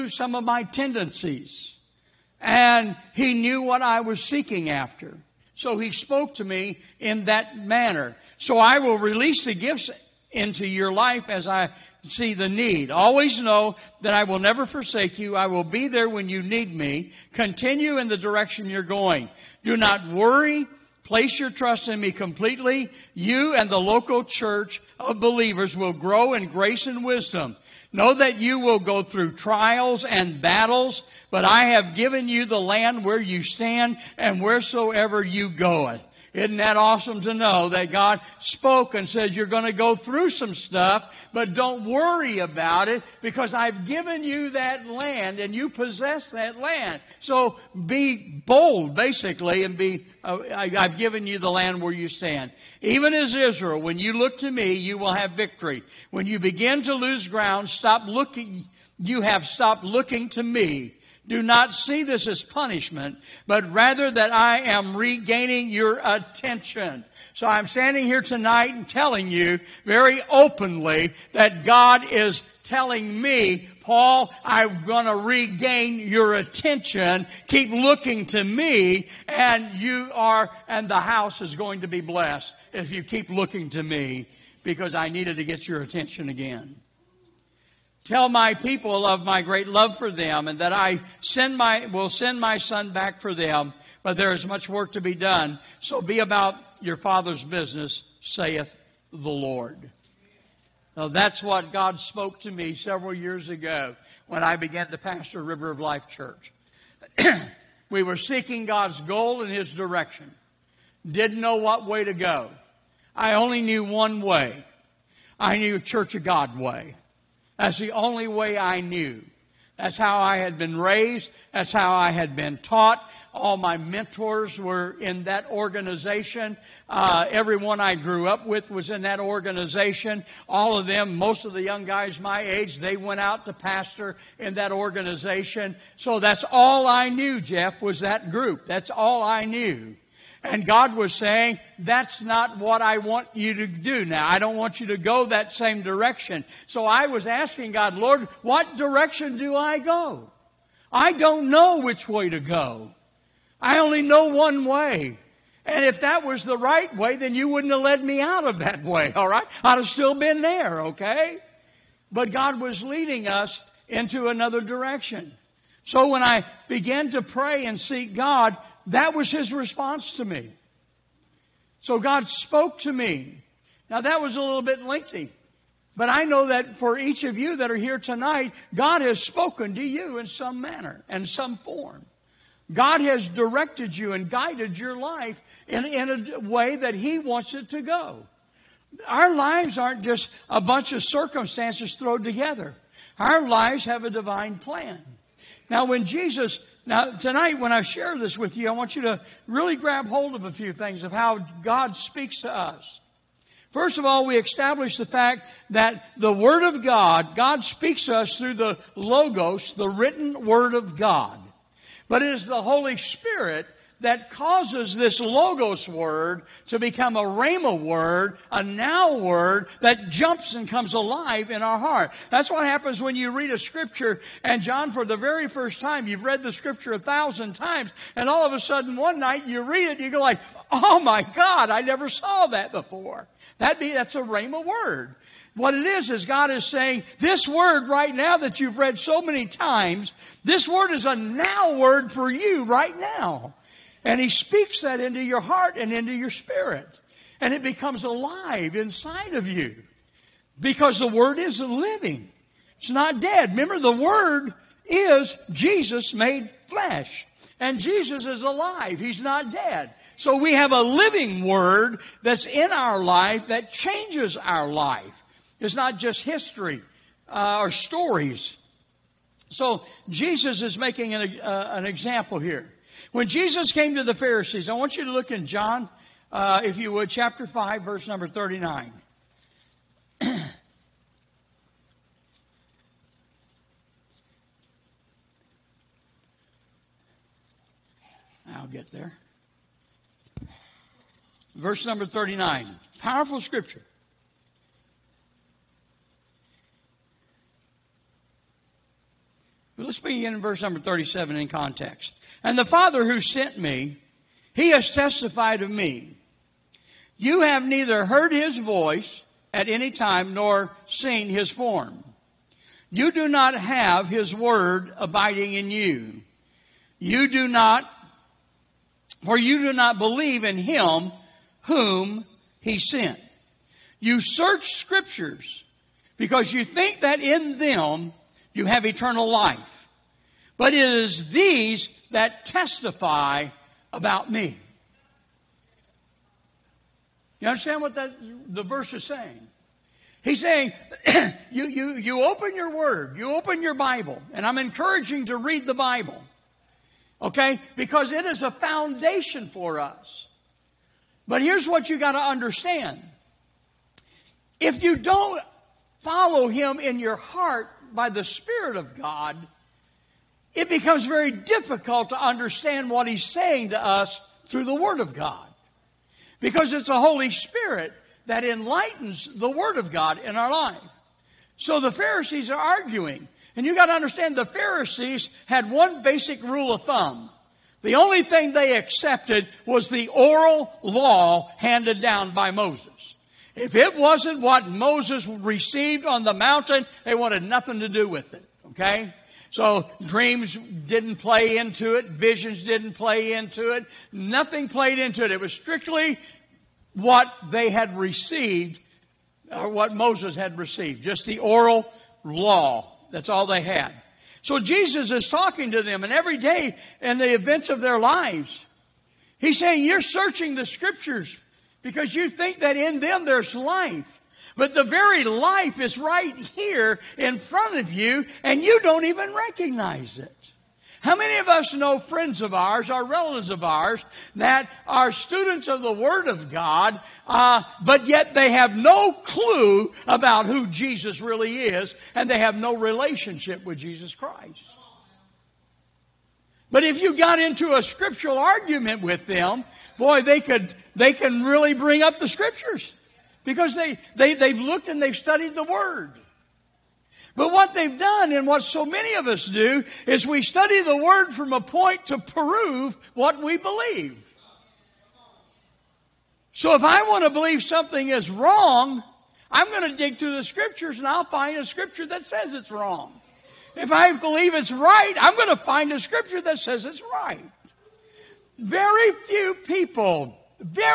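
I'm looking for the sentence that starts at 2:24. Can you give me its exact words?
I don't want you to go that same direction.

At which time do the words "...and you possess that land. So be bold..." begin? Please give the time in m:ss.
0:45.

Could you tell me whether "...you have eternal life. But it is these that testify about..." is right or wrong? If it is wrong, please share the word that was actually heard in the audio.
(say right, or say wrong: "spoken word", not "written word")
right.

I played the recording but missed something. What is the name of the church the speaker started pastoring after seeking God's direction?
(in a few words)
River of Life Church.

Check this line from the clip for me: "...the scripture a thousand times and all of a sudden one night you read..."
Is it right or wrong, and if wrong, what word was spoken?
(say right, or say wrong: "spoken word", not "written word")
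right.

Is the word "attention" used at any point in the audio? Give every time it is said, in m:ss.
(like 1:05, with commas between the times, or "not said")
1:06, 1:16, 1:25.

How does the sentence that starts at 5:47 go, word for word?
Because it is a foundation for us.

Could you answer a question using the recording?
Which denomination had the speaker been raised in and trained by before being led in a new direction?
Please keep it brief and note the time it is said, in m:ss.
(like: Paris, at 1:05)
Church of God, at 1:55.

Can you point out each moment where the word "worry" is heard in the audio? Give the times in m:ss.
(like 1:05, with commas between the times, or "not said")
0:20, 0:41.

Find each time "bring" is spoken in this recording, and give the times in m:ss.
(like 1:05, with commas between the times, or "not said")
7:21.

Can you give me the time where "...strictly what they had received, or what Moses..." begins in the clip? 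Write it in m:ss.
6:35.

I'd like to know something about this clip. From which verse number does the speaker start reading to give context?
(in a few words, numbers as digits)
37.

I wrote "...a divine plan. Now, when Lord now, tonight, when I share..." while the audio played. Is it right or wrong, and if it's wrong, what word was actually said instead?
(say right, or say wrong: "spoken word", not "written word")
wrong: "Jesus", not "Lord".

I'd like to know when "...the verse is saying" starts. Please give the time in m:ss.
5:38.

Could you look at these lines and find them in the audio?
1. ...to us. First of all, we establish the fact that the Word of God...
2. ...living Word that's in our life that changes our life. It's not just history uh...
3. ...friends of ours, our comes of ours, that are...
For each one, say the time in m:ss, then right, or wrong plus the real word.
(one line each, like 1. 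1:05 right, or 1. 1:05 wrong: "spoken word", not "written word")
1. 3:22 right
2. 4:20 right
3. 7:01 wrong: "relatives", not "comes".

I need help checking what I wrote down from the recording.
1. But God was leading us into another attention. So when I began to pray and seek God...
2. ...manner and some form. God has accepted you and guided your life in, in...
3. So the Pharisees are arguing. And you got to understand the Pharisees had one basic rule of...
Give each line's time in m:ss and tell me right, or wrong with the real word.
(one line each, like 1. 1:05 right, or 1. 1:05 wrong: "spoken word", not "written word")
1. 2:42 wrong: "direction", not "attention"
2. 3:00 wrong: "directed", not "accepted"
3. 6:11 right.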